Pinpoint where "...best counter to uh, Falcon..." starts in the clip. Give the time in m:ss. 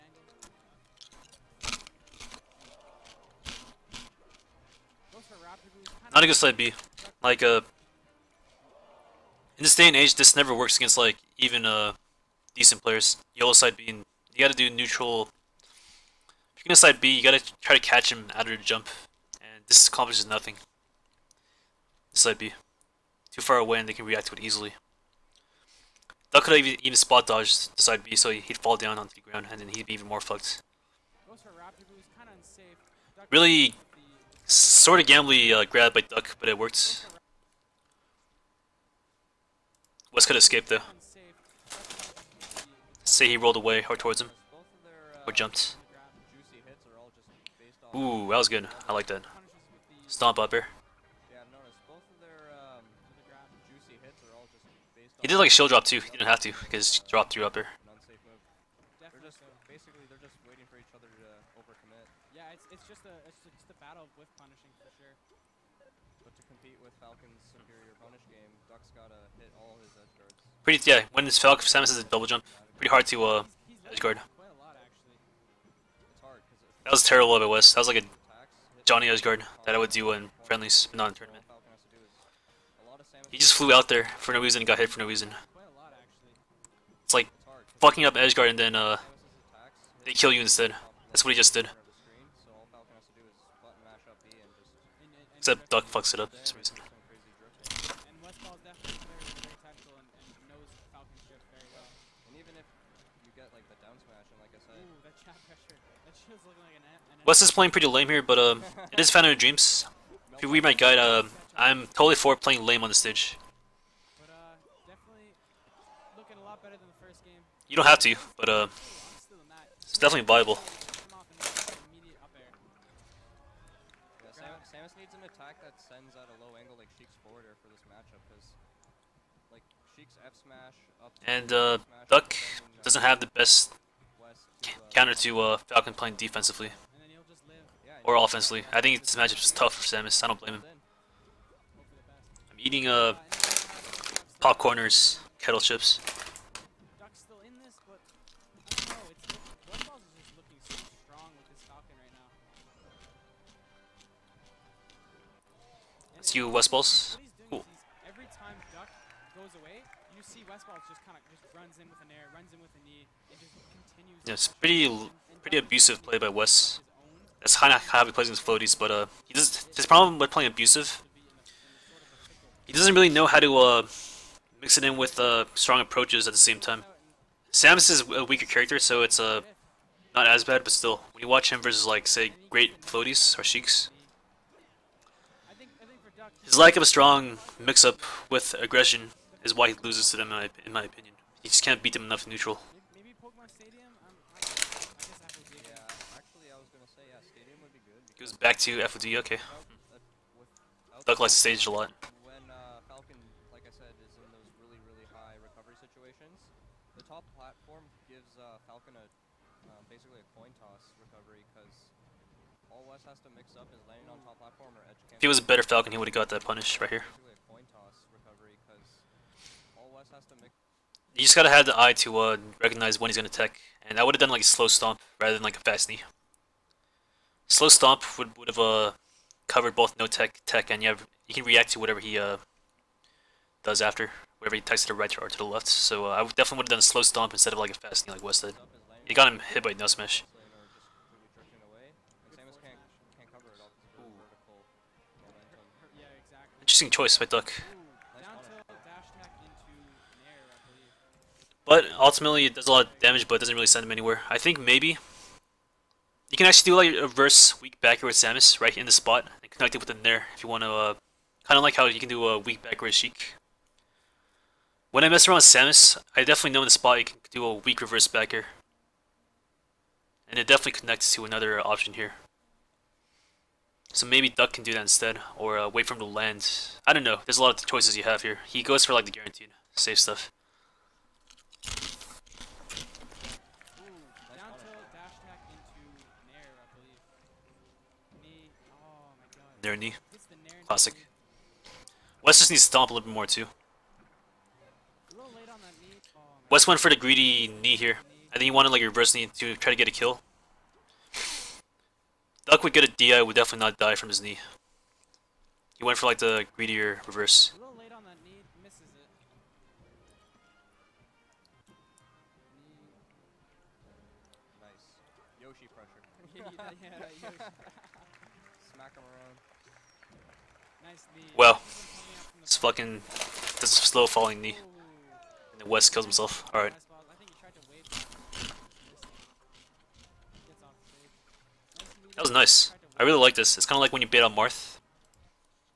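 2:13.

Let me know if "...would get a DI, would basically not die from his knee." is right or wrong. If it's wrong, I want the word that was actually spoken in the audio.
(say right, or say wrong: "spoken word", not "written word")
wrong: "definitely", not "basically".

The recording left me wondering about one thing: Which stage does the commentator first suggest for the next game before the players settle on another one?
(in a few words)
Pokemon Stadium.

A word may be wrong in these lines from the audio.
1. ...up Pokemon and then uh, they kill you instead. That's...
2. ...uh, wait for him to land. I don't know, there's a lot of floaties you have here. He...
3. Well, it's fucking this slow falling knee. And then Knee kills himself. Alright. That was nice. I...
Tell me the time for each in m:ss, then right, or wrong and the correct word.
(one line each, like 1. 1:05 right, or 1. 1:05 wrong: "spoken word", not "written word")
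1. 1:28 wrong: "Edgeguard", not "Pokemon"
2. 4:35 wrong: "choices", not "floaties"
3. 5:21 wrong: "West", not "Knee".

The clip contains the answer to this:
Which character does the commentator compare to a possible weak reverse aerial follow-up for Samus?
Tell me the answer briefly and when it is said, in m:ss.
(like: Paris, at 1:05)
Sheik, at 4:22.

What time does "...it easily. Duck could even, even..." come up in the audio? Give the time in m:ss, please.
0:24.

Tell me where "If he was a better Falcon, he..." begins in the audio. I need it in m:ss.
3:35.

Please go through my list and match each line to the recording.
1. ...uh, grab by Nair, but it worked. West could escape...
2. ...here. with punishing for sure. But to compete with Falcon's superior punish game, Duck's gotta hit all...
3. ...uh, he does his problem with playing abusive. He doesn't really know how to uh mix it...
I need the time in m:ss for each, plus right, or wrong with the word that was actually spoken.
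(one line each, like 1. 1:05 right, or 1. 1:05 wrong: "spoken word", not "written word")
1. 0:35 wrong: "Duck", not "Nair"
2. 0:57 right
3. 2:48 right.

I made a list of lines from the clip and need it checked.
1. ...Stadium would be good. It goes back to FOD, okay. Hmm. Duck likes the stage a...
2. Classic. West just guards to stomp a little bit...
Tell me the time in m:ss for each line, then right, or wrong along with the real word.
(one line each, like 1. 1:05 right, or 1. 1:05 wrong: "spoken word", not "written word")
1. 3:17 right
2. 4:50 wrong: "needs", not "guards".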